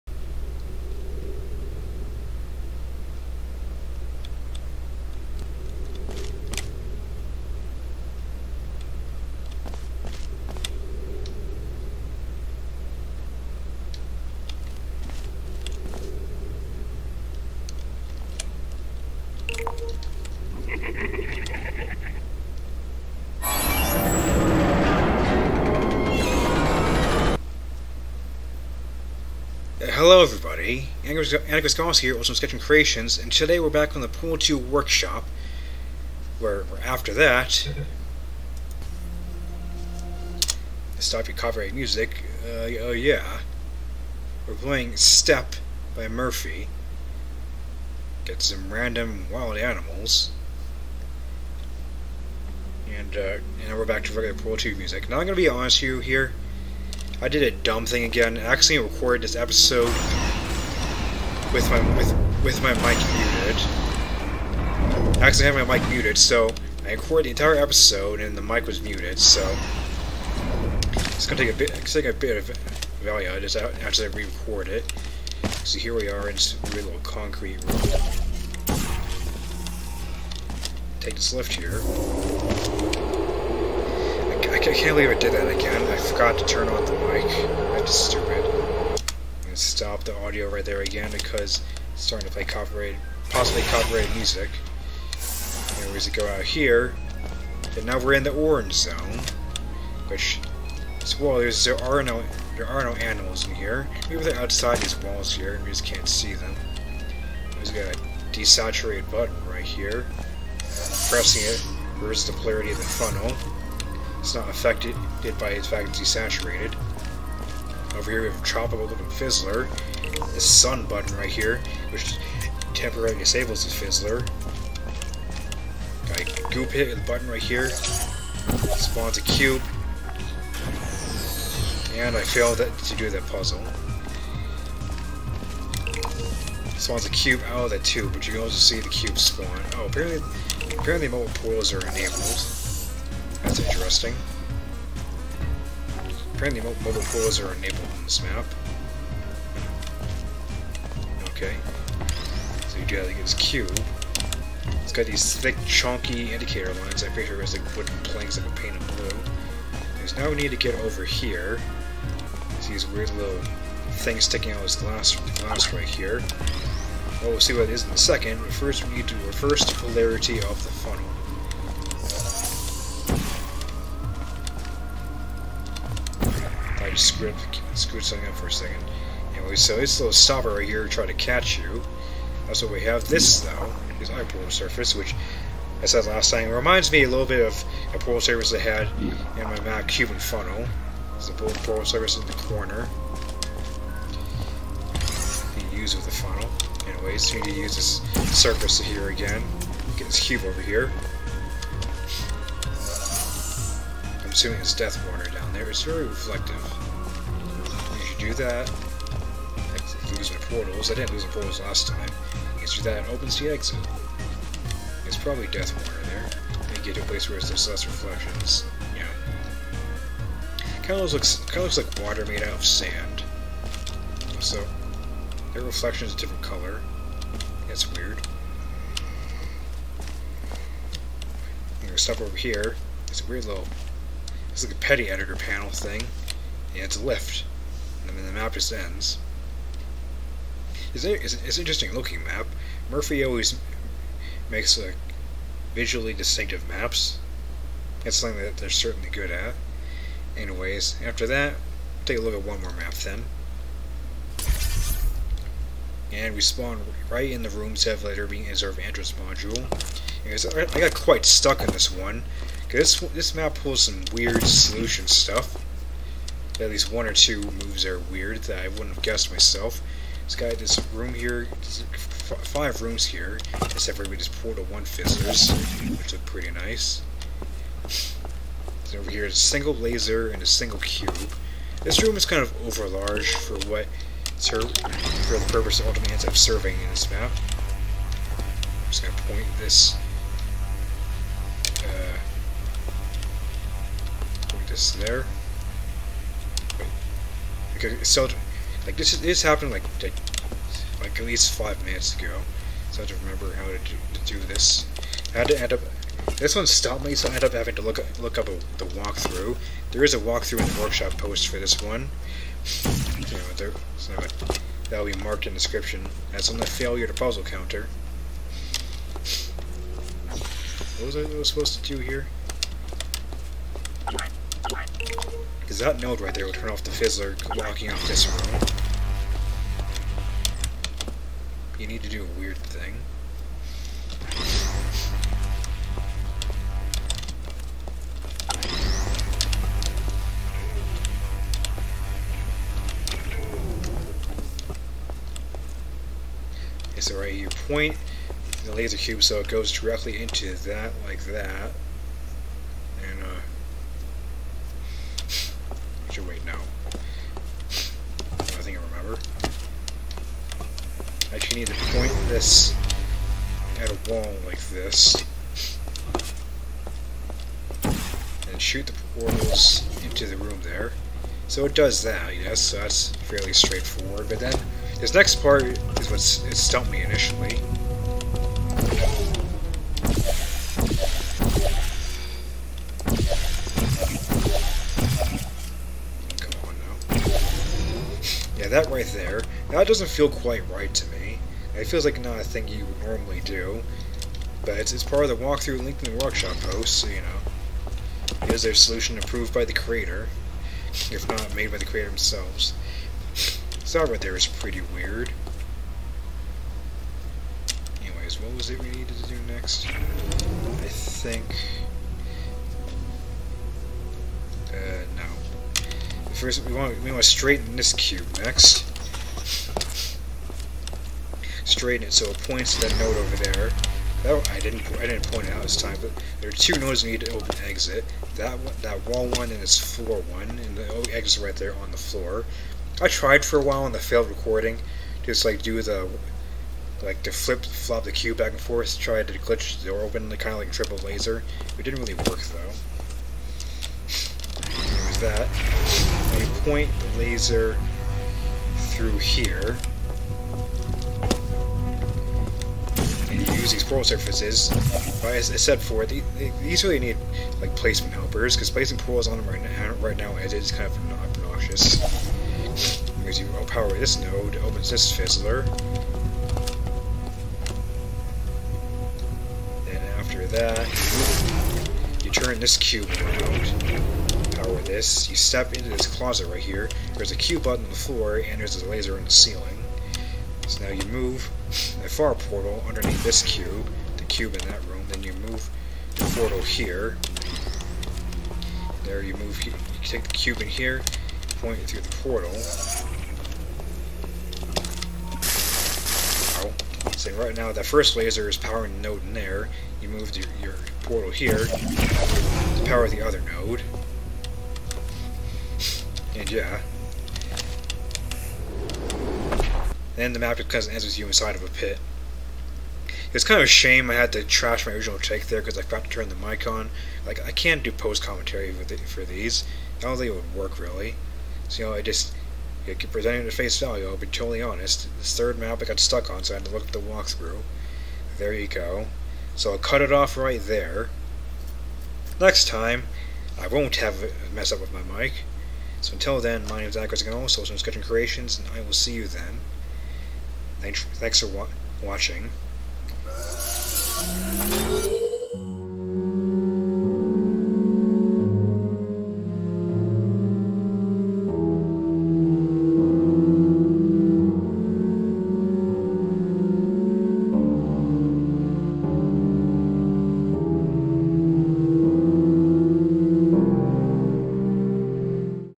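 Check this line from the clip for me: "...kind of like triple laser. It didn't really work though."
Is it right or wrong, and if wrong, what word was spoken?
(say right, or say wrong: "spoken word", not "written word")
right.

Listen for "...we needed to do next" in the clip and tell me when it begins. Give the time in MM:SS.
06:48.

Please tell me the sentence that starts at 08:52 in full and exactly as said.
Next time, I won't have a mess up with my mic.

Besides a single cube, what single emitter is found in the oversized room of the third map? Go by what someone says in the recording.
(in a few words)
a laser.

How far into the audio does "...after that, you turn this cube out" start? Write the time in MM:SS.
07:50.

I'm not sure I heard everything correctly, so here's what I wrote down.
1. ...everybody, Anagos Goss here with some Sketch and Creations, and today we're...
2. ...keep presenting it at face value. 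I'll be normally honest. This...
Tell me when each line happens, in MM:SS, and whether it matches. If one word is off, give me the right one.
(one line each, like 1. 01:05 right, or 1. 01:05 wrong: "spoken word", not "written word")
1. 00:30 right
2. 08:42 wrong: "totally", not "normally".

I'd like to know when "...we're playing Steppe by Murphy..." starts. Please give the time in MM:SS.
00:44.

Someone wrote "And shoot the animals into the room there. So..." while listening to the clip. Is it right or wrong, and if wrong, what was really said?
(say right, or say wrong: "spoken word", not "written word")
wrong: "portals", not "animals".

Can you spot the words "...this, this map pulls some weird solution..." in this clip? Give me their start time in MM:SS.
04:22.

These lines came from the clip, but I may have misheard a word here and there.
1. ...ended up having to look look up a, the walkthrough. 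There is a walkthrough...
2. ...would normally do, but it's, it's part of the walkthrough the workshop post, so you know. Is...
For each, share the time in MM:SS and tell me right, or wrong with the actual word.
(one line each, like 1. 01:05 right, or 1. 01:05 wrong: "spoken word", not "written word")
1. 05:07 right
2. 06:32 right.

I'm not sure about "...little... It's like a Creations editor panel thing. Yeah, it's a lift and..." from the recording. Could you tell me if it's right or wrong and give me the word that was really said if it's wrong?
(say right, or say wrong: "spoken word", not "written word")
wrong: "PeTI", not "Creations".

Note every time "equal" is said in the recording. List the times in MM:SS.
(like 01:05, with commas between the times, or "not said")
not said.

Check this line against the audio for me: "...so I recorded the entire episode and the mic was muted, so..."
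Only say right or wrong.
right.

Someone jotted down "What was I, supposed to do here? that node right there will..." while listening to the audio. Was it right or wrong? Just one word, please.
right.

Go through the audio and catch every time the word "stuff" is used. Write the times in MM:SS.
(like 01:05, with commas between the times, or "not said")
03:52, 04:25.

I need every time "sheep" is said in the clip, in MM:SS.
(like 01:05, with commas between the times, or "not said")
not said.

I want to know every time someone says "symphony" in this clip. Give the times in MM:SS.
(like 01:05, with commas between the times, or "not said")
not said.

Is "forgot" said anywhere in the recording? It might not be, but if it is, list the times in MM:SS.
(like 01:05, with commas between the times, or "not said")
01:25, 08:35.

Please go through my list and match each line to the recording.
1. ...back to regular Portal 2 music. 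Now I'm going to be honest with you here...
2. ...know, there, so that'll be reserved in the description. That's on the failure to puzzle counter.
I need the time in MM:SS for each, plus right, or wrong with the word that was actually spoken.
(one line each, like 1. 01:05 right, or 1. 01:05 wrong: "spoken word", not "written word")
1. 00:53 right
2. 05:13 wrong: "marked", not "reserved".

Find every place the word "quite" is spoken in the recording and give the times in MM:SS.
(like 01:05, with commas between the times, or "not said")
04:20, 06:30.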